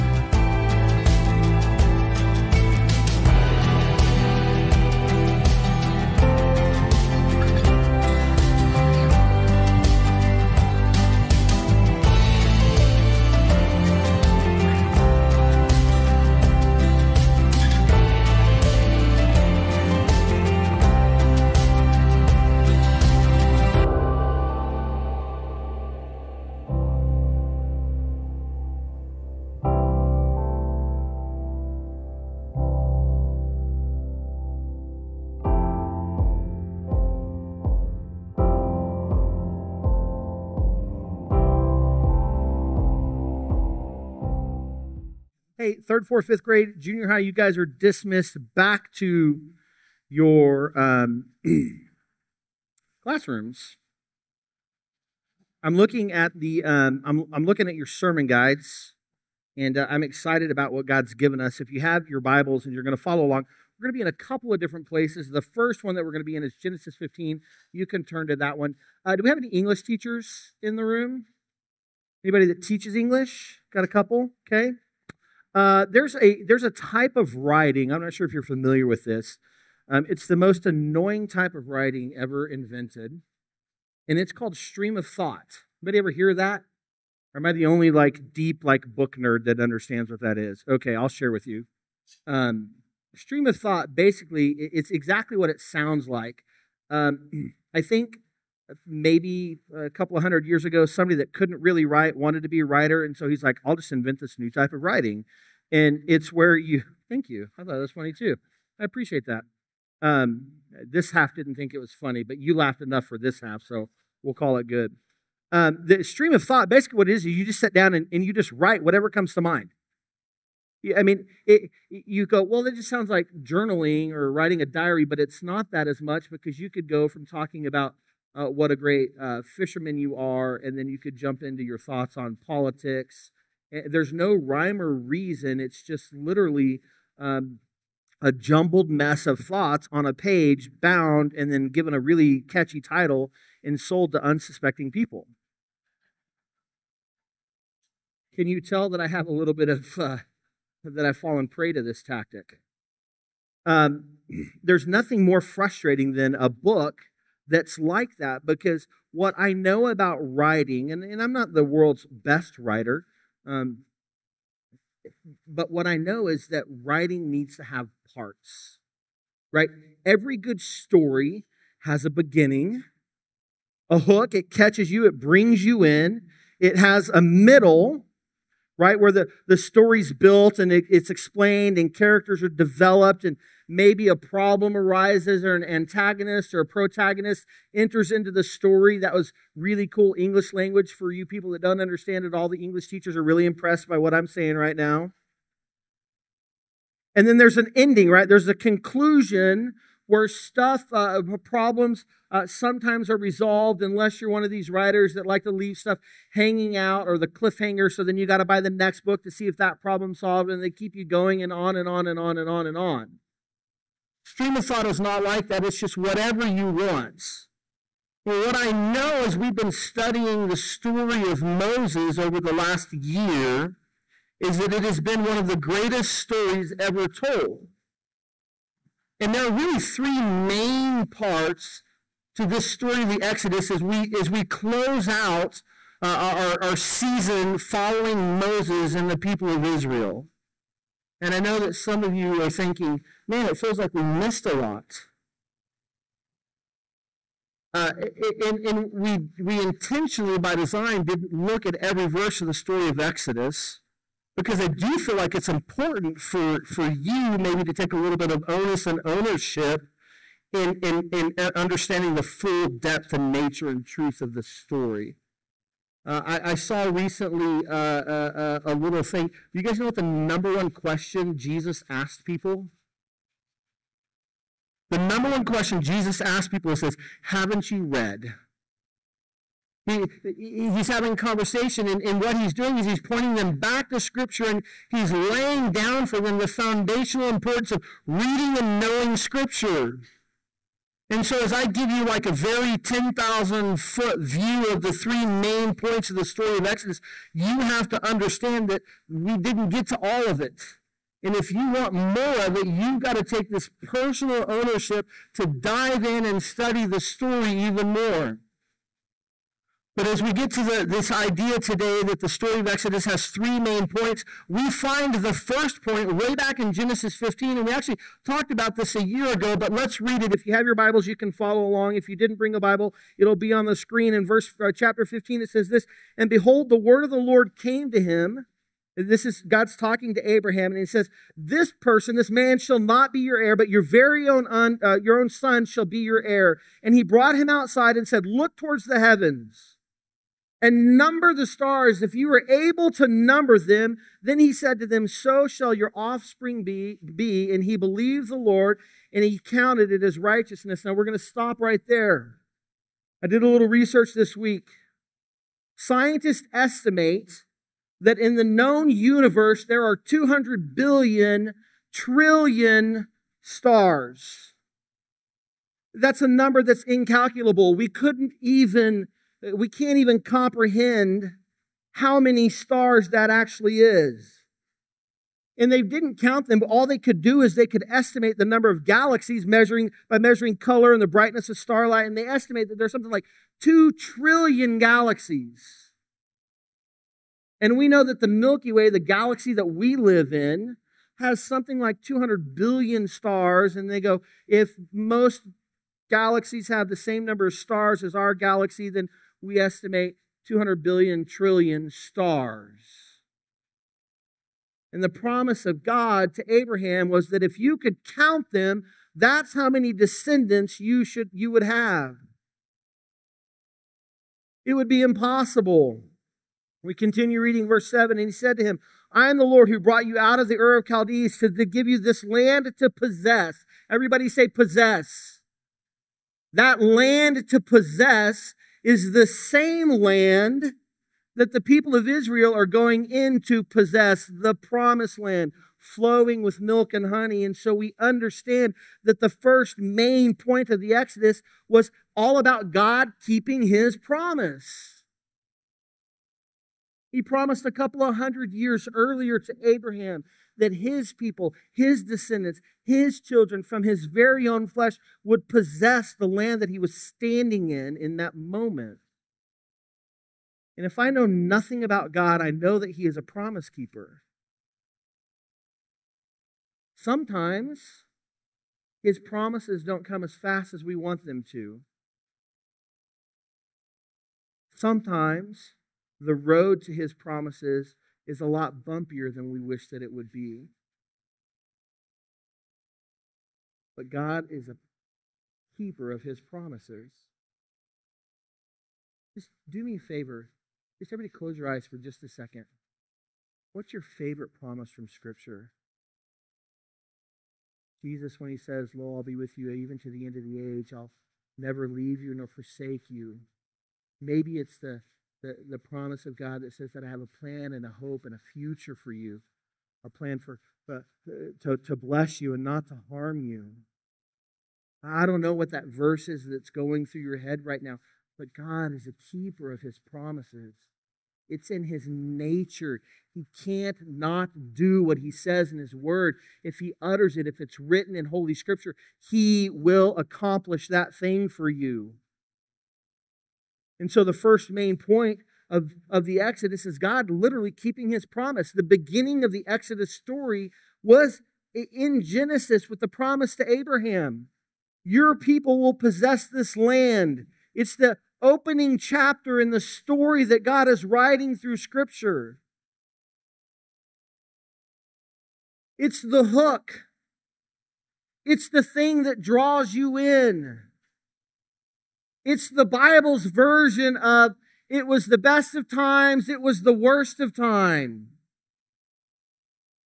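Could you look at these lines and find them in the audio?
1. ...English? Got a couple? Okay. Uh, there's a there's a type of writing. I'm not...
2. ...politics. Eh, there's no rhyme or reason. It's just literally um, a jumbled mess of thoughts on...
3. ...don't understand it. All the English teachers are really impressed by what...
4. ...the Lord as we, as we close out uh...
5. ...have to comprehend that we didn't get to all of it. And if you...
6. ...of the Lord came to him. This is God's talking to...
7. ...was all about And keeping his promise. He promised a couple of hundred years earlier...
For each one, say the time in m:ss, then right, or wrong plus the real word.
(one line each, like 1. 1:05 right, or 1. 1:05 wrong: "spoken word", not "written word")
1. 1:12 right
2. 2:12 right
3. 3:11 right
4. 3:53 wrong: "Exodus", not "Lord"
5. 4:57 wrong: "understand", not "comprehend"
6. 5:27 right
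7. 7:21 wrong: "God", not "And".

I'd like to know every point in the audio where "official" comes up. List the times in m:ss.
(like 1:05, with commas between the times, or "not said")
not said.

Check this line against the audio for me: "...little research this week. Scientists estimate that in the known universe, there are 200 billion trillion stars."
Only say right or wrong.
right.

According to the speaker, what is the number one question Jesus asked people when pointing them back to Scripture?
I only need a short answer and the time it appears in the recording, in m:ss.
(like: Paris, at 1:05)
Haven't you read?, at 4:37.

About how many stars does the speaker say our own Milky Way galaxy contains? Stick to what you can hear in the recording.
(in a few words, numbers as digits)
200 billion.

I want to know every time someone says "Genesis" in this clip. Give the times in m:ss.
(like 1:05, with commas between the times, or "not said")
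1:06, 5:16, 9:02.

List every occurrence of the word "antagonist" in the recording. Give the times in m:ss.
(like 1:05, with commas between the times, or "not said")
3:05.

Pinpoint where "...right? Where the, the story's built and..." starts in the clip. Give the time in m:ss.
2:58.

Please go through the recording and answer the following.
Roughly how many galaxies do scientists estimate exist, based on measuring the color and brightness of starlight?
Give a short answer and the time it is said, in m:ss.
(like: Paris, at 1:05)
2 trillion, at 6:23.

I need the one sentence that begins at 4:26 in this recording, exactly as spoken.
Uh, I, I, saw recently uh, a, uh, uh, a, little thing.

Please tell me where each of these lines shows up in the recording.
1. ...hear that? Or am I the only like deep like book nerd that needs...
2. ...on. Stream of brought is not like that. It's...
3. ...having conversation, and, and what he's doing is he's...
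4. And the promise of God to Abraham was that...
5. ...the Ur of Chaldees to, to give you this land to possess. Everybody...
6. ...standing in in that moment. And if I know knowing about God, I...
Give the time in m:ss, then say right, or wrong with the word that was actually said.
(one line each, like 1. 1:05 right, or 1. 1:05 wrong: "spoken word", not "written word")
1. 1:26 wrong: "understands", not "needs"
2. 3:32 wrong: "thought", not "brought"
3. 4:40 right
4. 6:44 right
5. 7:00 right
6. 7:36 wrong: "nothing", not "knowing".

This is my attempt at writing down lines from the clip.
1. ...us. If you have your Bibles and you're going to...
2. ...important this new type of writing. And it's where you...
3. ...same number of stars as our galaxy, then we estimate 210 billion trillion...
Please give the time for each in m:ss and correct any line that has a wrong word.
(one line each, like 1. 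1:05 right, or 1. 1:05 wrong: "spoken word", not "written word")
1. 1:01 right
2. 1:43 wrong: "invent", not "important"
3. 6:36 wrong: "200", not "210".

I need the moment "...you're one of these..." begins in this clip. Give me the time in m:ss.
3:24.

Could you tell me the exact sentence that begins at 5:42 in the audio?
If you were able to number them, then he said to them, So shall your offspring be.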